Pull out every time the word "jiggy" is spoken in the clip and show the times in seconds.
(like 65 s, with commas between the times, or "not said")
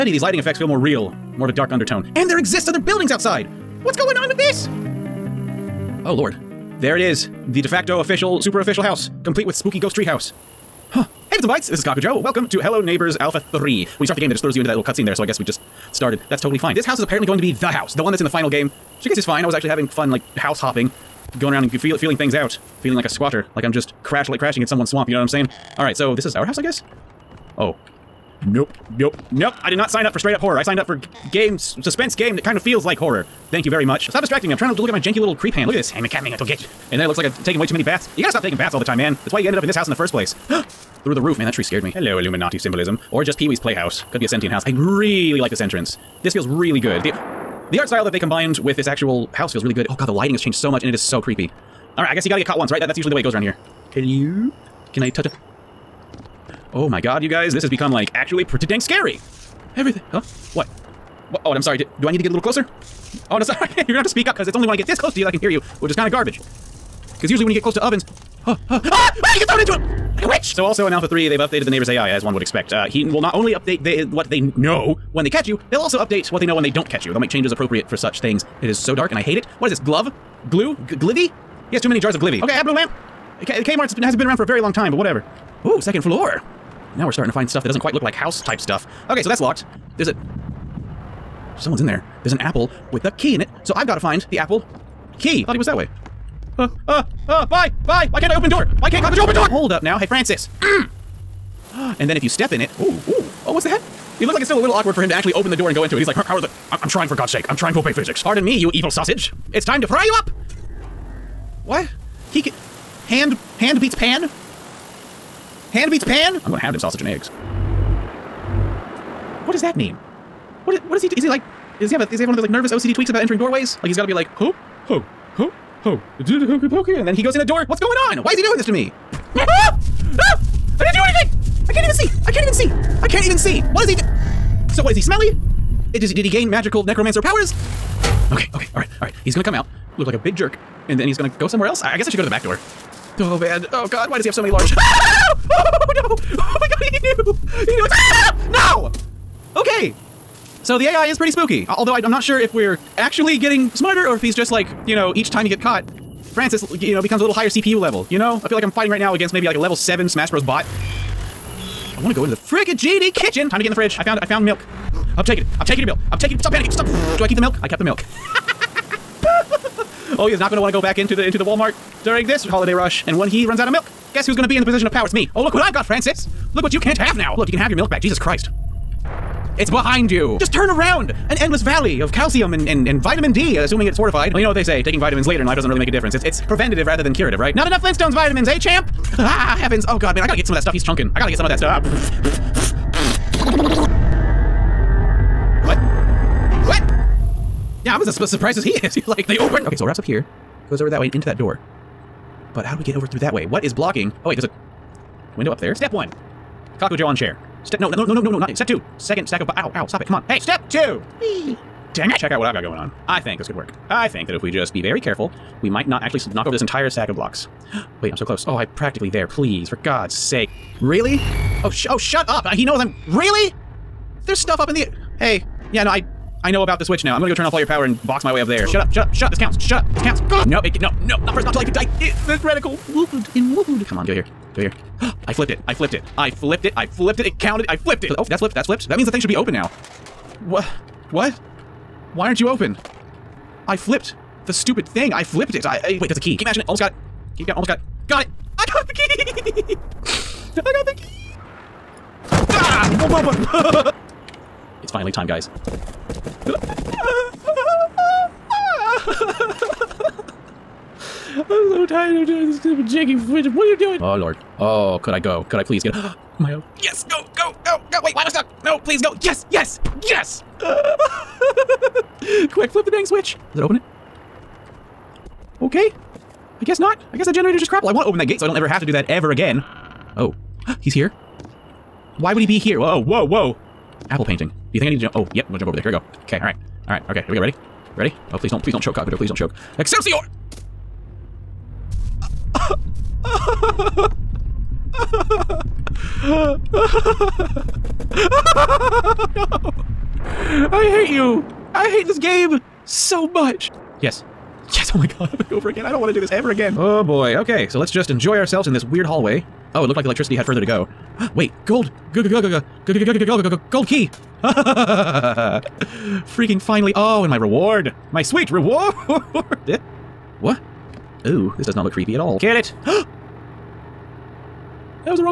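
262 s.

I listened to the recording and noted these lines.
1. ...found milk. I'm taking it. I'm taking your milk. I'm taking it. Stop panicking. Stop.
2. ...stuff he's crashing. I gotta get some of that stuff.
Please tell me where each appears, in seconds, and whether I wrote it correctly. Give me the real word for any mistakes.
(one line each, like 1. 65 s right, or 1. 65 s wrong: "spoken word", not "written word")
1. 164 s right
2. 190 s wrong: "chunking", not "crashing".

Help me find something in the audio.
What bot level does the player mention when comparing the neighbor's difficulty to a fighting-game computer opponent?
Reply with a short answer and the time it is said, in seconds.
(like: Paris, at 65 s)
7, at 159 s.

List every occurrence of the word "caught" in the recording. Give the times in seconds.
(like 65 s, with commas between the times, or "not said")
52 s, 155 s.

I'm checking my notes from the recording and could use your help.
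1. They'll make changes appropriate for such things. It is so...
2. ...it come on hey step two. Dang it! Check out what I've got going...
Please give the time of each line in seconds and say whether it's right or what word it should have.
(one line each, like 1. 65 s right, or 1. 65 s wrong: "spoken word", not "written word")
1. 77 s right
2. 210 s right.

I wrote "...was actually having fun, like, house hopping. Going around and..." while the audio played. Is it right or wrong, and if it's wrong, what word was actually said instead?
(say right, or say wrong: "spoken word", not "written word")
right.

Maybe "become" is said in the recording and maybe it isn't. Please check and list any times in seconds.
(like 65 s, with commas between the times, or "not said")
57 s, 157 s.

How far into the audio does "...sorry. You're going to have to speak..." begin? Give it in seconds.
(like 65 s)
63 s.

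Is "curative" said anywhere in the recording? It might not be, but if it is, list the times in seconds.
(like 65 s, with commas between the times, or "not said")
187 s.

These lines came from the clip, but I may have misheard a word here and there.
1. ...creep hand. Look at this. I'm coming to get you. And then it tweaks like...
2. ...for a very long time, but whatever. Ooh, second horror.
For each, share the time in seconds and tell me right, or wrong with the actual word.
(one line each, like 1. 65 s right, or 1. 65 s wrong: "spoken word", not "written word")
1. 35 s wrong: "looks", not "tweaks"
2. 84 s wrong: "floor", not "horror".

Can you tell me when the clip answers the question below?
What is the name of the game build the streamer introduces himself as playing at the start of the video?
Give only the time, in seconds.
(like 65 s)
12 s.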